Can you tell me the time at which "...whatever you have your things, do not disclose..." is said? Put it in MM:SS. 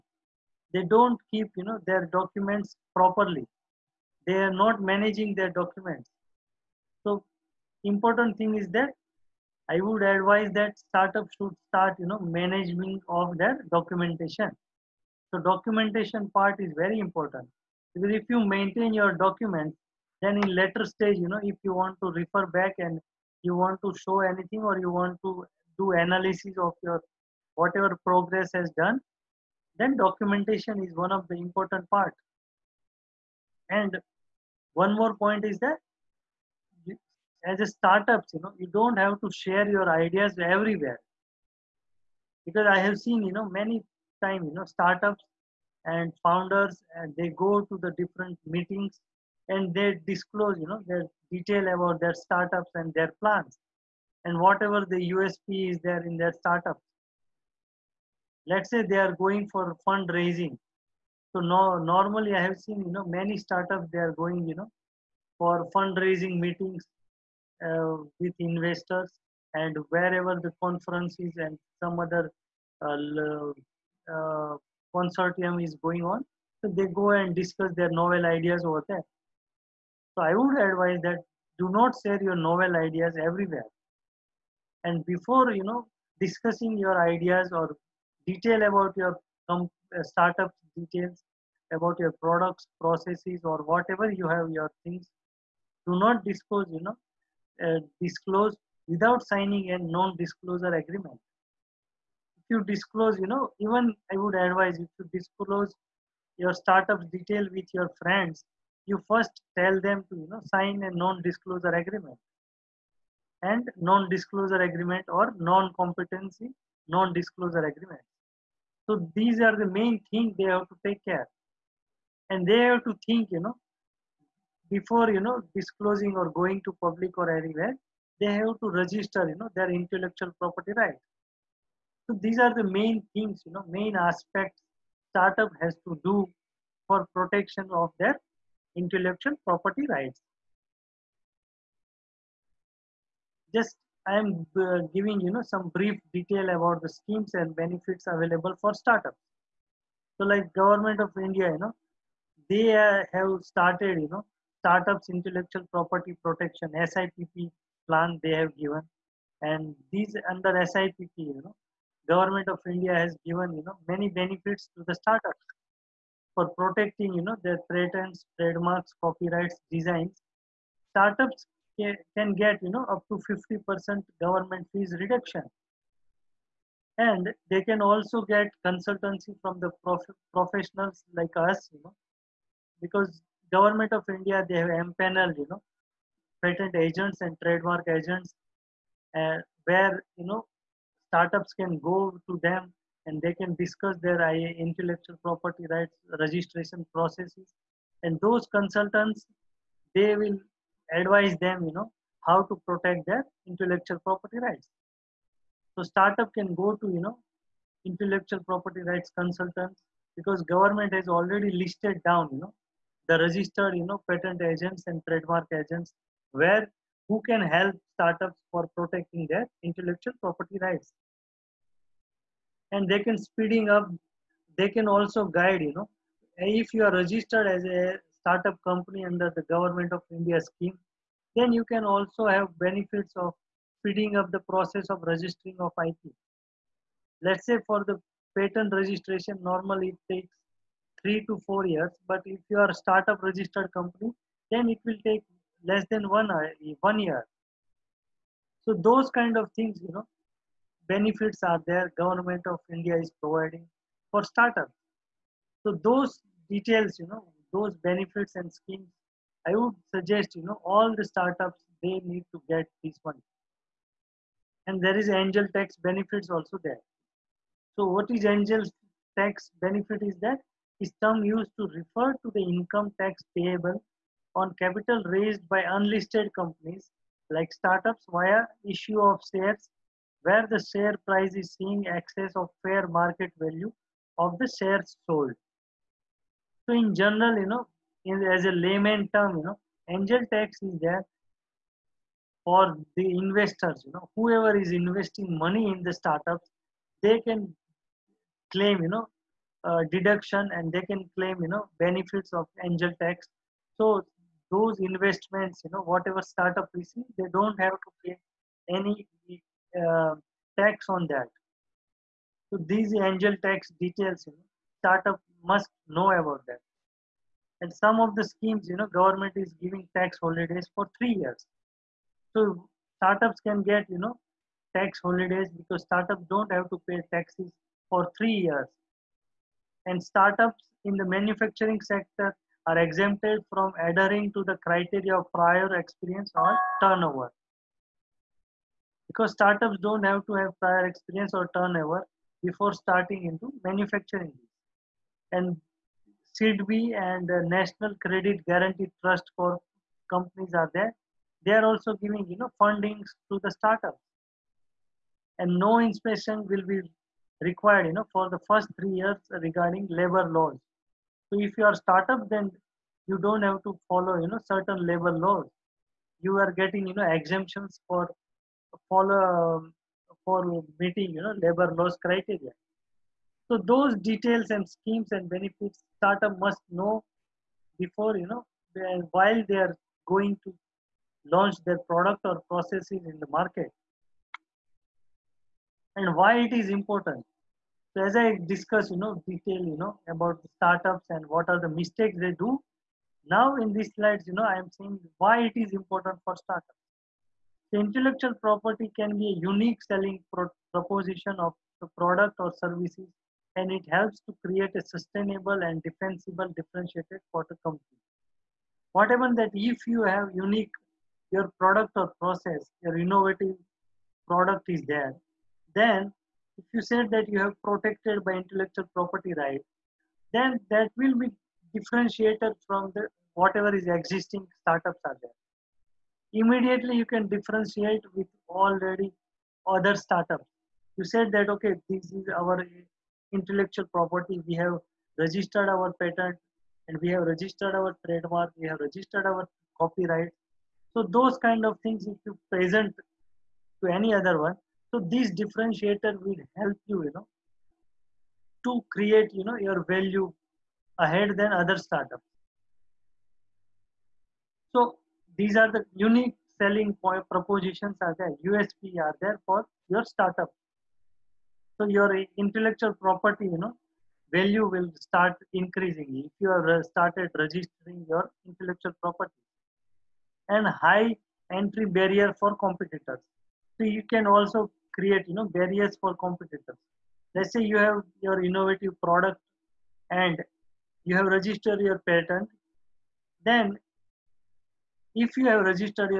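01:33.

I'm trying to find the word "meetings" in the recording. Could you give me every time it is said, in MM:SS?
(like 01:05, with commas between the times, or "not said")
00:48, 01:06, 06:10.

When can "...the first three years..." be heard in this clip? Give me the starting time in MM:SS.
05:58.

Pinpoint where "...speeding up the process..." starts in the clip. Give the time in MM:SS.
03:53.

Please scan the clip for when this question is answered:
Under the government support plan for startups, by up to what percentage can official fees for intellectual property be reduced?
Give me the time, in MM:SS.
02:53.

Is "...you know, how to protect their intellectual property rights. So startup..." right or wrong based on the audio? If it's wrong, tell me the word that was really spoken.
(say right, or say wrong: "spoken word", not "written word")
right.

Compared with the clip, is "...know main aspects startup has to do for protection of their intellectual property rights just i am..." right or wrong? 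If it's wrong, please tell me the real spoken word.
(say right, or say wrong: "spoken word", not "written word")
right.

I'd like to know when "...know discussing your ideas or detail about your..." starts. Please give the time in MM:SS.
01:25.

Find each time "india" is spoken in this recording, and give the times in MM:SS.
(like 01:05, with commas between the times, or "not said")
02:31, 02:42, 03:04, 03:50, 04:12.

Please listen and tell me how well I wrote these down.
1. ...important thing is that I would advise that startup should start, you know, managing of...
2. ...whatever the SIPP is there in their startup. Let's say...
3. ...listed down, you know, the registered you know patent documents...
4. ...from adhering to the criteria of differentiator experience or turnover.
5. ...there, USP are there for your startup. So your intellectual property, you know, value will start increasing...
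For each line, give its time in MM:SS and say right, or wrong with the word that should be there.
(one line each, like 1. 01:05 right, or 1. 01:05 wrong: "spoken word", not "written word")
1. 00:07 right
2. 00:54 wrong: "USP", not "SIPP"
3. 03:31 wrong: "agents", not "documents"
4. 05:33 wrong: "prior", not "differentiator"
5. 07:38 right.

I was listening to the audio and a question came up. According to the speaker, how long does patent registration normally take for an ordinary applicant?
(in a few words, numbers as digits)
3 to 4 years.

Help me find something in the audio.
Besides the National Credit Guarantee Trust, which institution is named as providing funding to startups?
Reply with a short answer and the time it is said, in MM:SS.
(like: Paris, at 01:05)
SIDBI, at 05:46.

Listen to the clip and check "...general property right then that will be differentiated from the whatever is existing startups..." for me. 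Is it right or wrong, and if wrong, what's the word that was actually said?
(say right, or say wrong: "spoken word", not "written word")
wrong: "intellectual", not "general".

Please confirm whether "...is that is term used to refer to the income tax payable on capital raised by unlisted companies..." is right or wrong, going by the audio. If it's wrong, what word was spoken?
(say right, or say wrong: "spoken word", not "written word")
right.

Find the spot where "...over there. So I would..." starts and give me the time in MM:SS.
01:18.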